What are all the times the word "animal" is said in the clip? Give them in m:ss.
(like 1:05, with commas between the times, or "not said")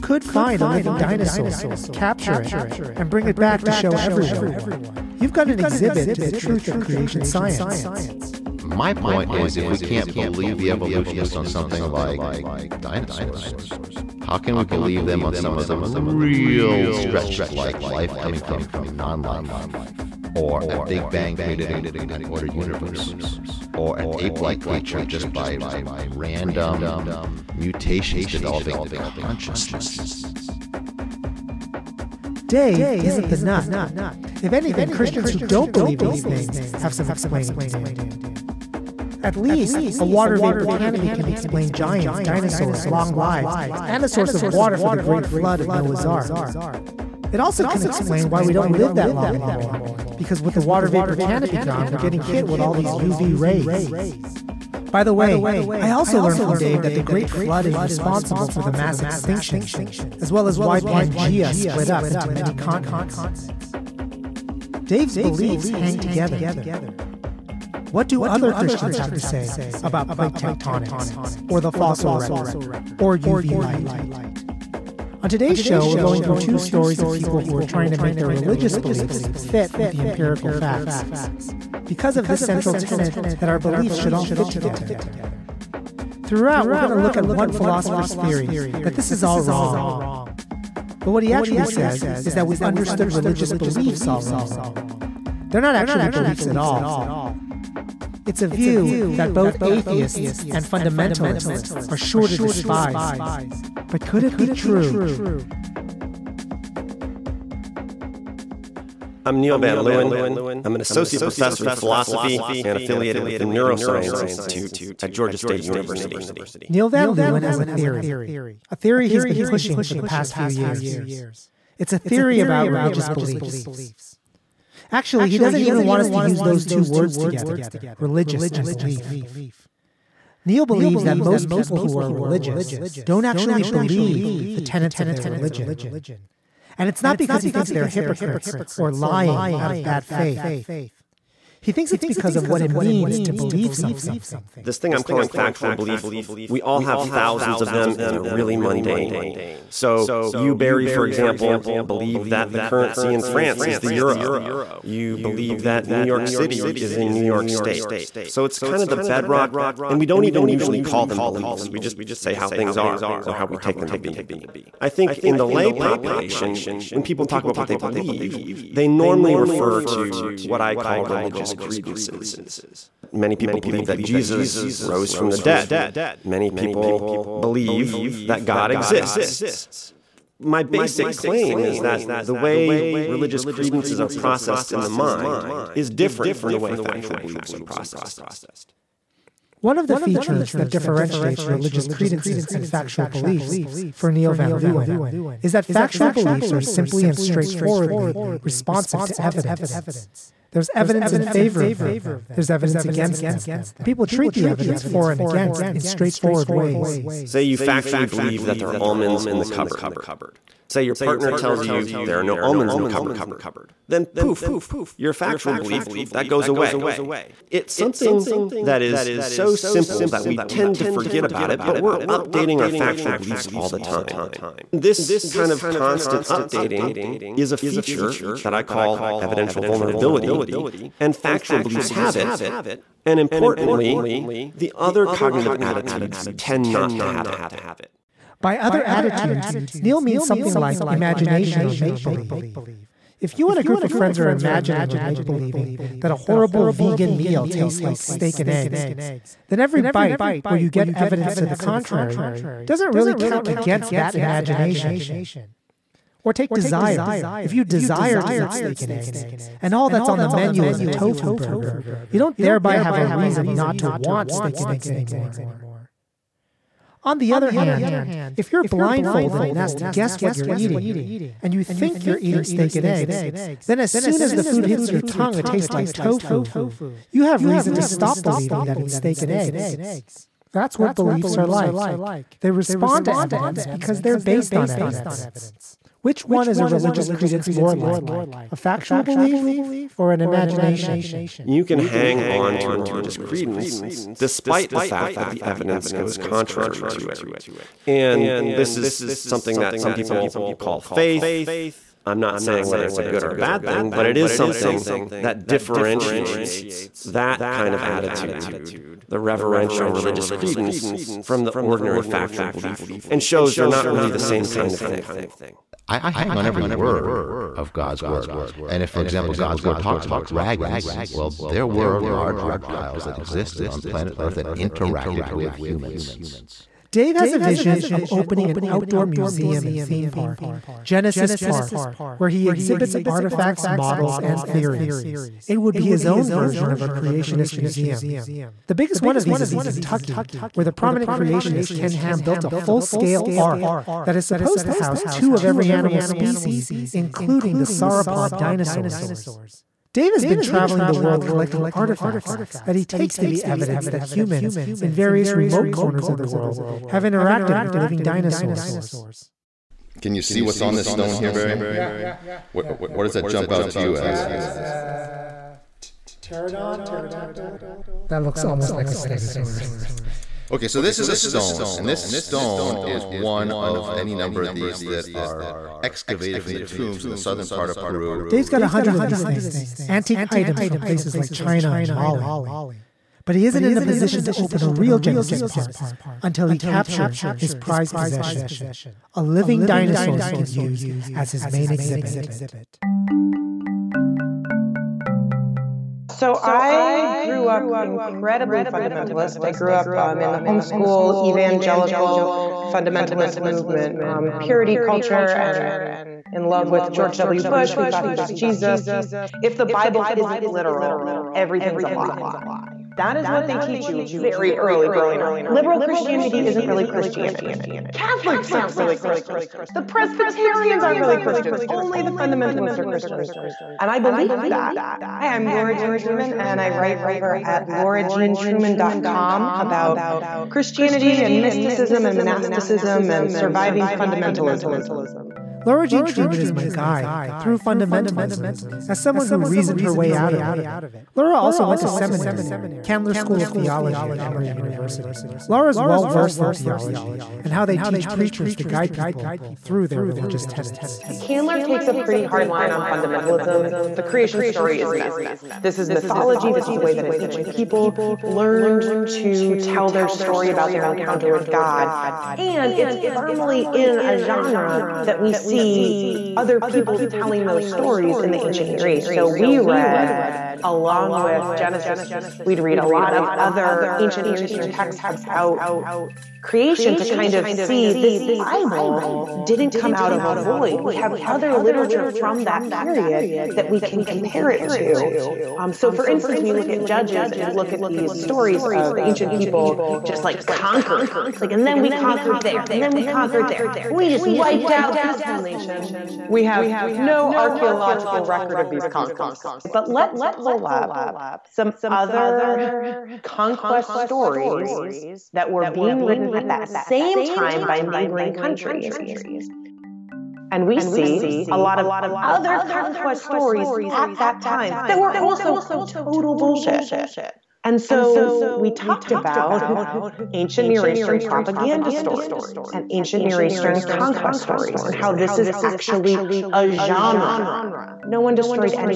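5:45.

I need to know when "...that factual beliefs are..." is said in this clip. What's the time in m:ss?
3:15.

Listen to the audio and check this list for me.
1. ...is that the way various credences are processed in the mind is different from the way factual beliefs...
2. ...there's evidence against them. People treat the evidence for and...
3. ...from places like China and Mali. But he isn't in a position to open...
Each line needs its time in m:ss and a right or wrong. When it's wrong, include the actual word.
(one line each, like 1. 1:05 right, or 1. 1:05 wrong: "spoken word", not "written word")
1. 3:01 wrong: "religious", not "various"
2. 3:22 right
3. 6:20 right.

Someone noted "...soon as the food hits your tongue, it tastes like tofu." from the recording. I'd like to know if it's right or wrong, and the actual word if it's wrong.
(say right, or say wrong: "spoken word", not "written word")
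right.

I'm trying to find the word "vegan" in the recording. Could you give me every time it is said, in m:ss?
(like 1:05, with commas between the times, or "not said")
4:06.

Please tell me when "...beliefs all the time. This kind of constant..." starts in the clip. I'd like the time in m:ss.
3:43.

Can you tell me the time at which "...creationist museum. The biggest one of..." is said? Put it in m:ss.
5:36.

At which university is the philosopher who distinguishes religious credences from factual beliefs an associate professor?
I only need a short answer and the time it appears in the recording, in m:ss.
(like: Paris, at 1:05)
Georgia State University, at 1:55.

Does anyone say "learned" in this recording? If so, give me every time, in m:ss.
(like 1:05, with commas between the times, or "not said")
0:56, 7:38.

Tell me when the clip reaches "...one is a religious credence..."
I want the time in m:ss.
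4:46.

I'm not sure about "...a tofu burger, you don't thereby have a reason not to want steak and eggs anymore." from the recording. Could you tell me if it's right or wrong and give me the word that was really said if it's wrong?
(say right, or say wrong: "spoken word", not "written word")
right.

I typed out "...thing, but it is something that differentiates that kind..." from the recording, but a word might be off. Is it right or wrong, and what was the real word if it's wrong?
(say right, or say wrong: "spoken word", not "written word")
right.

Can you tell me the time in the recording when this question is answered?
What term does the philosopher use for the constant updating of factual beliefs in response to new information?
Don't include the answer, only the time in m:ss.
3:49.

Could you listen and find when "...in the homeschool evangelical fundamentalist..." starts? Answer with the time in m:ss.
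6:40.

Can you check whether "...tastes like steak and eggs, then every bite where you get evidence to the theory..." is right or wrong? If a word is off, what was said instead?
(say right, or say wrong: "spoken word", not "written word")
wrong: "contrary", not "theory".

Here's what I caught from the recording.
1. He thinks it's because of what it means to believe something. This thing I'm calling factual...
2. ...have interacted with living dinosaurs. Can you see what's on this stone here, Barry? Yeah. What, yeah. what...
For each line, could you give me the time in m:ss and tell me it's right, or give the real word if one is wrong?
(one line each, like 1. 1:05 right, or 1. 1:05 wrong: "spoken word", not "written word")
1. 2:21 right
2. 5:56 right.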